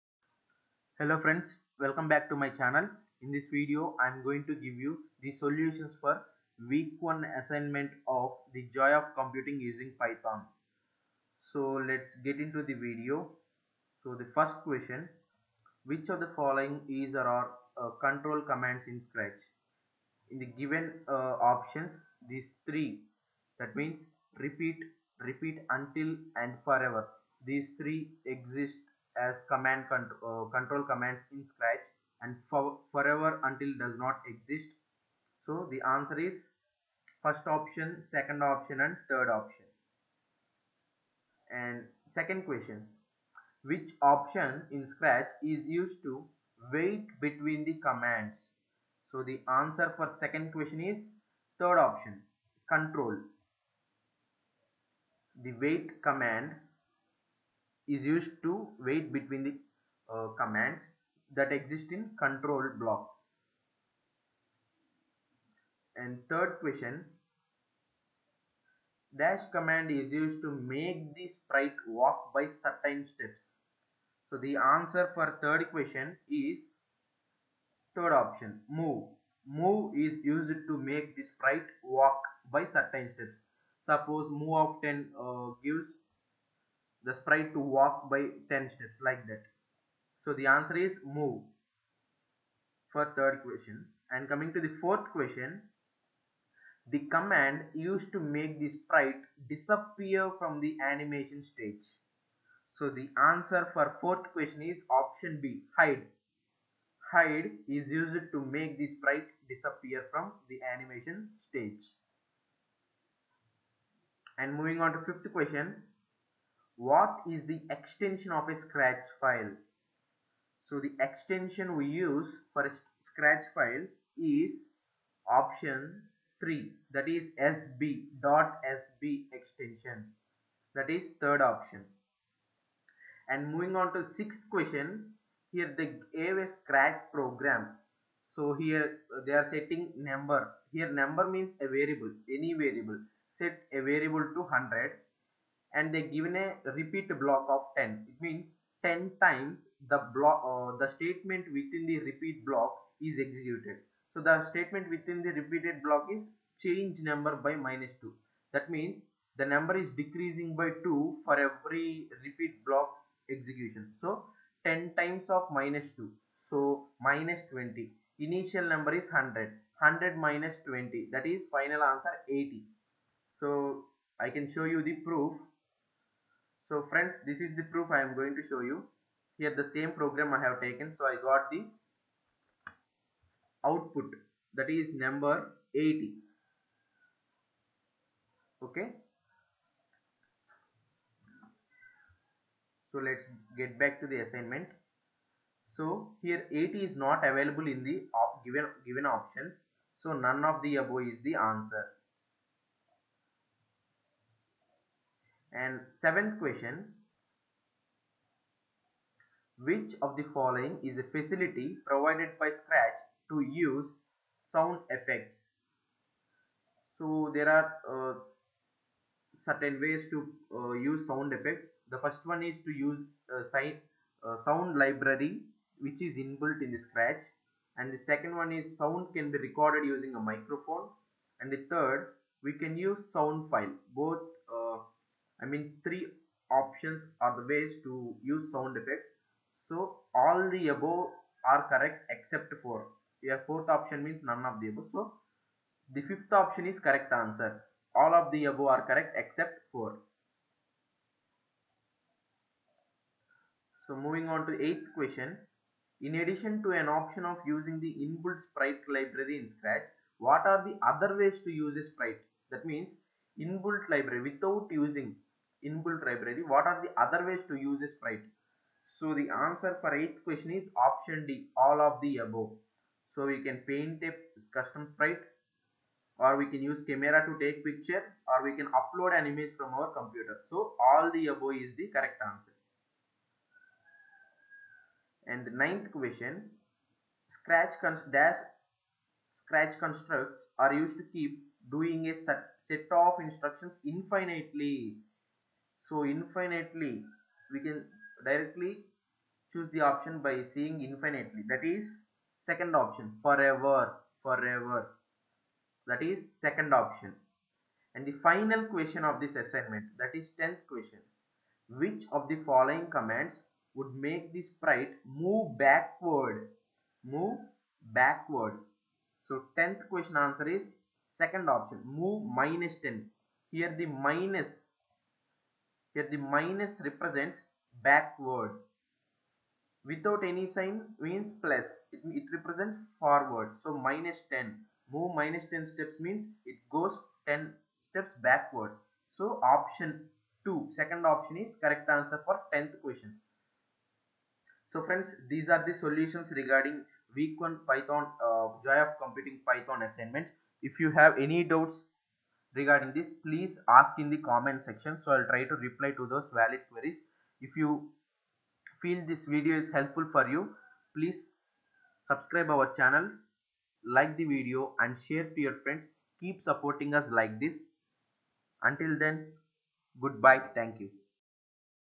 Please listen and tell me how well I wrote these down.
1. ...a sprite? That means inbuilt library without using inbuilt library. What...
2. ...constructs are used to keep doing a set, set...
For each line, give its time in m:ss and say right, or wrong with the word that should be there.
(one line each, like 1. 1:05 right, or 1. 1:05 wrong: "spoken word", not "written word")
1. 4:21 right
2. 4:49 right.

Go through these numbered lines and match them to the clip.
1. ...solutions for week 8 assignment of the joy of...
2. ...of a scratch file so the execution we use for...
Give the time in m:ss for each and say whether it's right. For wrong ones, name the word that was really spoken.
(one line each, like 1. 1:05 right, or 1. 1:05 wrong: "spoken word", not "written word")
1. 0:05 wrong: "1", not "8"
2. 1:58 wrong: "extension", not "execution".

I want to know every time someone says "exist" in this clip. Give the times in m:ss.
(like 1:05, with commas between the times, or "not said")
0:28, 0:34, 1:01.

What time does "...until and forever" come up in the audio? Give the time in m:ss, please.
0:25.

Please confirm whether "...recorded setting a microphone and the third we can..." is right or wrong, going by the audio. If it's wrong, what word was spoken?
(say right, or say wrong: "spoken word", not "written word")
wrong: "using", not "setting".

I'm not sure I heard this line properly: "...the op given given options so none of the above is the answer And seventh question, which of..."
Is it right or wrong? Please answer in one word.
right.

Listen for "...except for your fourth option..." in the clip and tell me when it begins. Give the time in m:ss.
4:02.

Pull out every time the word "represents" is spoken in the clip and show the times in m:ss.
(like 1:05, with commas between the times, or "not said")
5:26, 5:32.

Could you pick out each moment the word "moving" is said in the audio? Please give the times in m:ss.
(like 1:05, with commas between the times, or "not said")
1:54, 2:13, 4:13.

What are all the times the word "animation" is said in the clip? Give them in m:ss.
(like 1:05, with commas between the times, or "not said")
1:40, 1:50.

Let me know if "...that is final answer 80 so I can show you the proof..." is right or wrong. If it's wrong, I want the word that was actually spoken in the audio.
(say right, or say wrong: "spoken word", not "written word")
right.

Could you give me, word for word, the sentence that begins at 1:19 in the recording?
Move is used to make the sprite walk by certain steps.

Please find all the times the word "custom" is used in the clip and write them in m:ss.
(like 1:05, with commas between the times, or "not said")
4:34.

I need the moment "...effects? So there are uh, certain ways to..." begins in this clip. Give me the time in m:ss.
3:34.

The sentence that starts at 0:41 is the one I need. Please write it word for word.
And second question, which option in Scratch is used to wait between the commands?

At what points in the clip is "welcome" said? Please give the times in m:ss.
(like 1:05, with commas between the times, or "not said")
0:01.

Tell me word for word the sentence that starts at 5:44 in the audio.
So friends, these are the solutions regarding week 1 Python, uh, Joy of Computing Python assignments.